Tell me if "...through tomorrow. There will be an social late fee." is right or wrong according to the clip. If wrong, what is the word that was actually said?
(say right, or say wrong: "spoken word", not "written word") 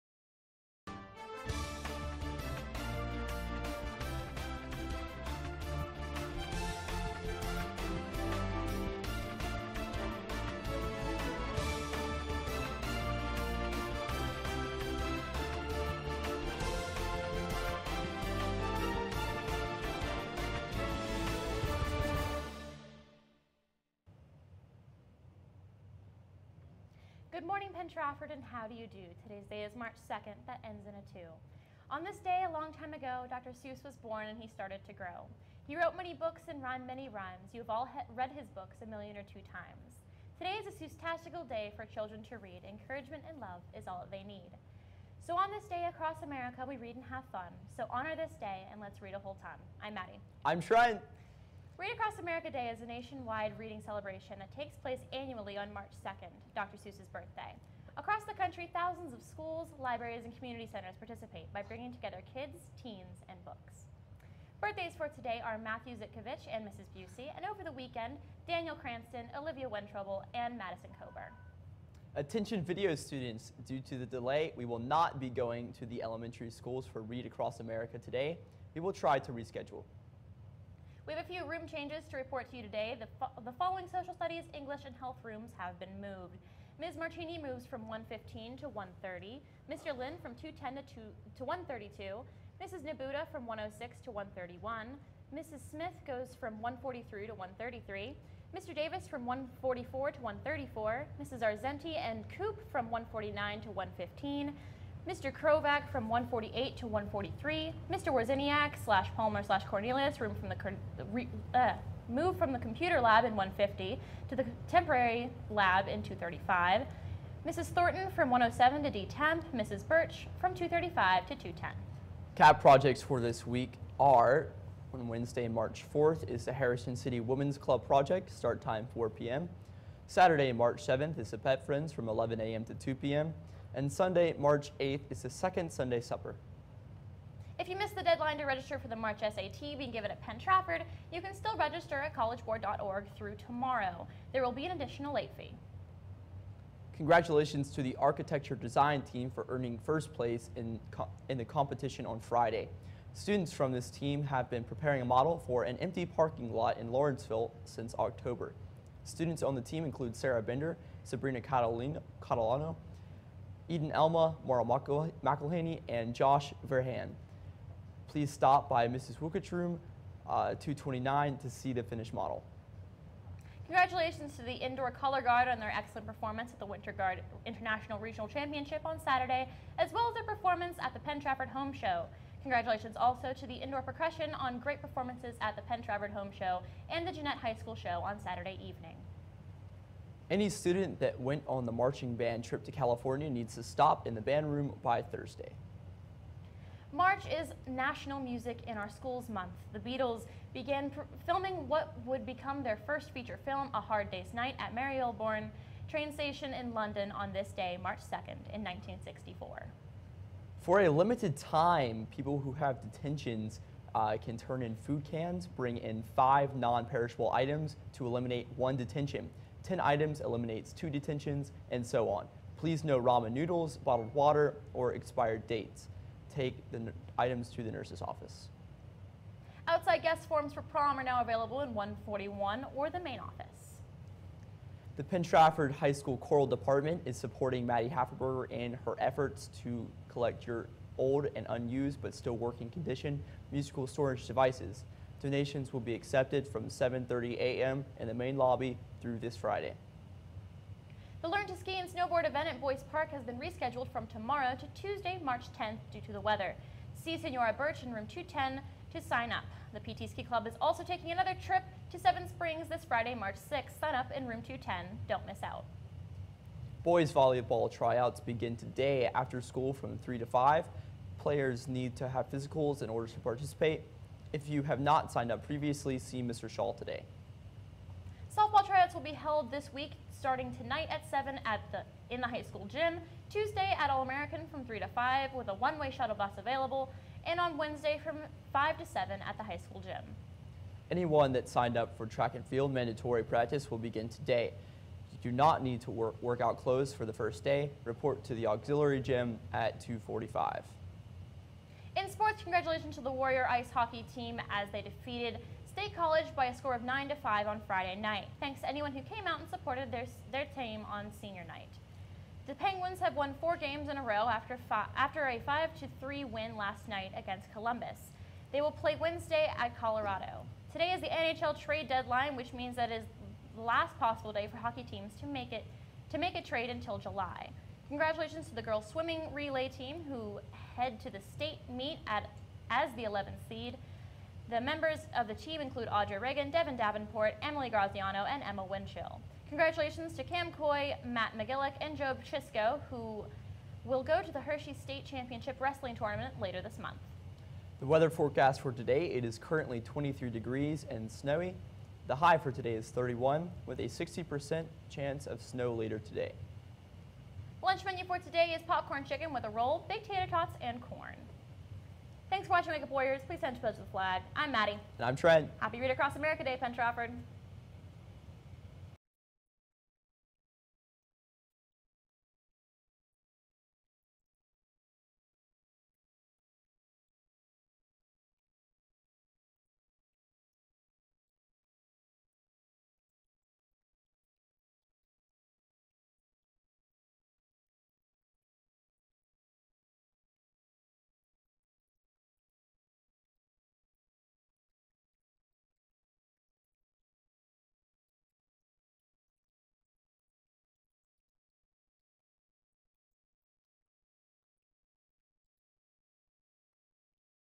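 wrong: "additional", not "social".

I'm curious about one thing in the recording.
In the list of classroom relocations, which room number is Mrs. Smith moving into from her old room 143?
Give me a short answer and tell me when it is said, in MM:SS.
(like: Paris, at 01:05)
133, at 01:37.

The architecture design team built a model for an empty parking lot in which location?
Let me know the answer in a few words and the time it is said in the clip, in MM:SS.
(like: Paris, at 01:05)
Lawrenceville, at 02:36.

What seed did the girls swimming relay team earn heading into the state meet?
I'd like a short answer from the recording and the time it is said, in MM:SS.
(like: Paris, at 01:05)
11th, at 05:33.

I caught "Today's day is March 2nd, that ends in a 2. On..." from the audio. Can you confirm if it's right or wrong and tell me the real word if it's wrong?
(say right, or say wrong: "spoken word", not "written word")
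right.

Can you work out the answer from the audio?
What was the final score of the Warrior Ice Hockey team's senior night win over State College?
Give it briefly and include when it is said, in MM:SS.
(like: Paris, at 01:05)
9 to 5, at 05:06.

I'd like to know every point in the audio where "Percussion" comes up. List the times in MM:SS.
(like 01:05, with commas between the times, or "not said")
03:03.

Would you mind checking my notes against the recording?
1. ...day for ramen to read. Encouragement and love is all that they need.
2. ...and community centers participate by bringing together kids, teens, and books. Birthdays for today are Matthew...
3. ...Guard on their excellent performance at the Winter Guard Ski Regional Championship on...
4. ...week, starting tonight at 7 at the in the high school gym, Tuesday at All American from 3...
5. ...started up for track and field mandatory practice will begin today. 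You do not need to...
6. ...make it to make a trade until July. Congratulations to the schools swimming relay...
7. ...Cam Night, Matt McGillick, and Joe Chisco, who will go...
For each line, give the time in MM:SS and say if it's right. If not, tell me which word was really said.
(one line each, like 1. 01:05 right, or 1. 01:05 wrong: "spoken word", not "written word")
1. 00:41 wrong: "children", not "ramen"
2. 01:00 right
3. 02:55 wrong: "International", not "Ski"
4. 04:39 right
5. 04:51 wrong: "signed", not "started"
6. 05:25 wrong: "girls", not "schools"
7. 05:40 wrong: "Coy", not "Night".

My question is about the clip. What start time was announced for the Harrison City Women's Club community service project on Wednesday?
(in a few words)
4 p.m.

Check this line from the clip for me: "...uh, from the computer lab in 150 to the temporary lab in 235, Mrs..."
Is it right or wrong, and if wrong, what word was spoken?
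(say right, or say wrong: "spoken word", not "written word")
right.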